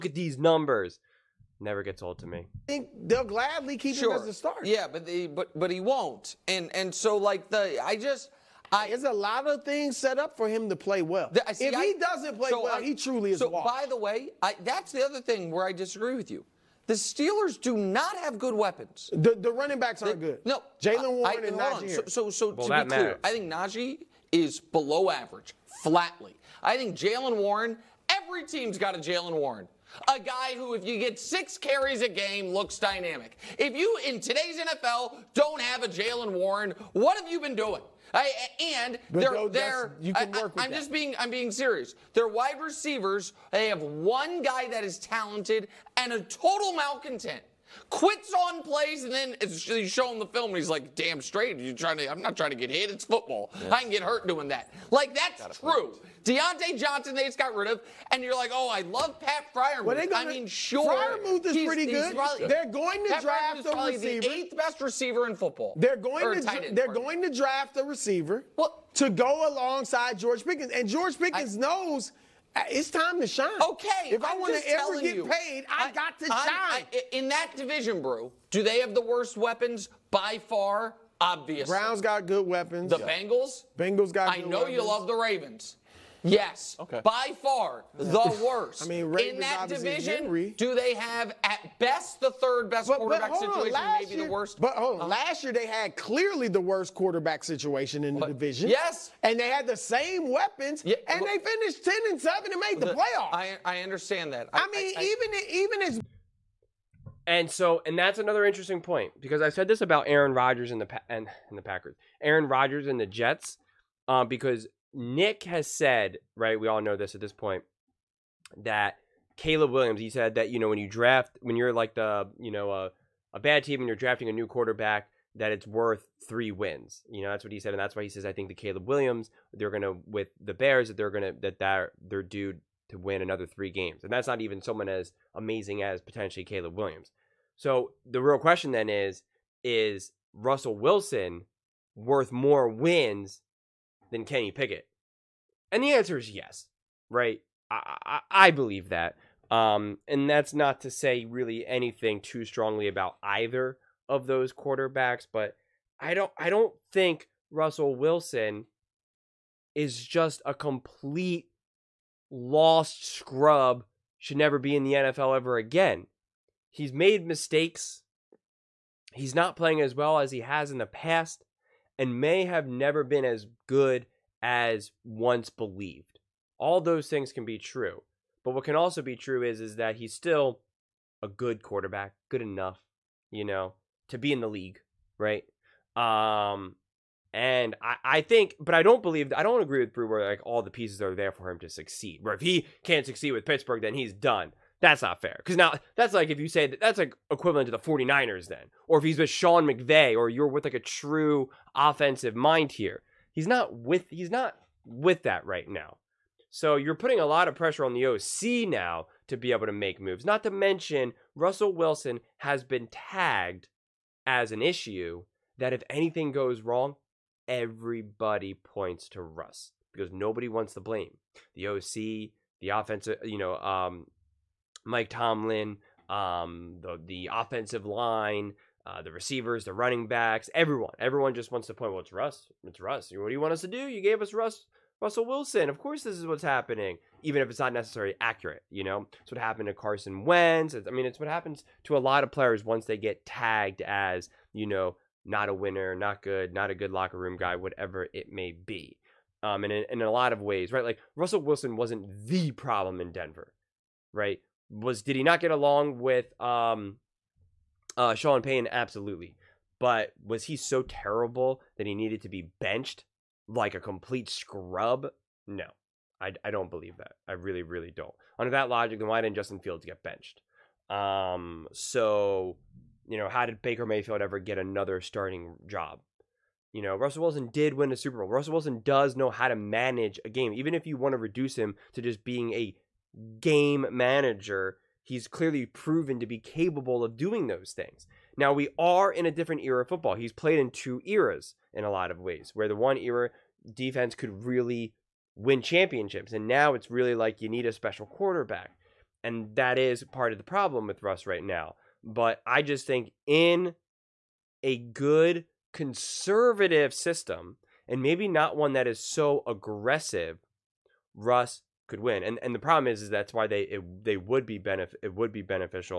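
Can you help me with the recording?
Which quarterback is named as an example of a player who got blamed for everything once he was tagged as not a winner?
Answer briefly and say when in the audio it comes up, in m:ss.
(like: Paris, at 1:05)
Carson Wentz, at 3:59.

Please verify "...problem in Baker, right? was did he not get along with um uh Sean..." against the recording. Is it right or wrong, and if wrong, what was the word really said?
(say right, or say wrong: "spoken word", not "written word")
wrong: "Denver", not "Baker".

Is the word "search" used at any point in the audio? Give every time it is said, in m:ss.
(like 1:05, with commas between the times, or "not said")
not said.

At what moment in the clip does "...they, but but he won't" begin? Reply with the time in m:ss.
0:05.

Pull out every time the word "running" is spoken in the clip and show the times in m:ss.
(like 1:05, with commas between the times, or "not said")
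0:19, 3:49.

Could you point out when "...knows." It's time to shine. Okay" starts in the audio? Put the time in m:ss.
1:11.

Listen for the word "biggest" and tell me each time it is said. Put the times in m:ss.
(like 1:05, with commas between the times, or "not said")
not said.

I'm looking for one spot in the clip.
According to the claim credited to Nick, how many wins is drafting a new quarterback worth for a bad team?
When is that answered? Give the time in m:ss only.
2:06.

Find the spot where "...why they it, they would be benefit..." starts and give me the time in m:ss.
5:13.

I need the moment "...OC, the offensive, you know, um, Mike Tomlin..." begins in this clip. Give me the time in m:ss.
3:41.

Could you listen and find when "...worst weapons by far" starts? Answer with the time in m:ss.
1:19.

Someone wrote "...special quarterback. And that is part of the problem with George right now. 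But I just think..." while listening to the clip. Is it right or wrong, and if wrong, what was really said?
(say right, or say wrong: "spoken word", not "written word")
wrong: "Russ", not "George".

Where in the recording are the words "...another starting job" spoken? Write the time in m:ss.
4:34.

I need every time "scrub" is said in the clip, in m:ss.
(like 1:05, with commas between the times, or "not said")
2:43, 4:24.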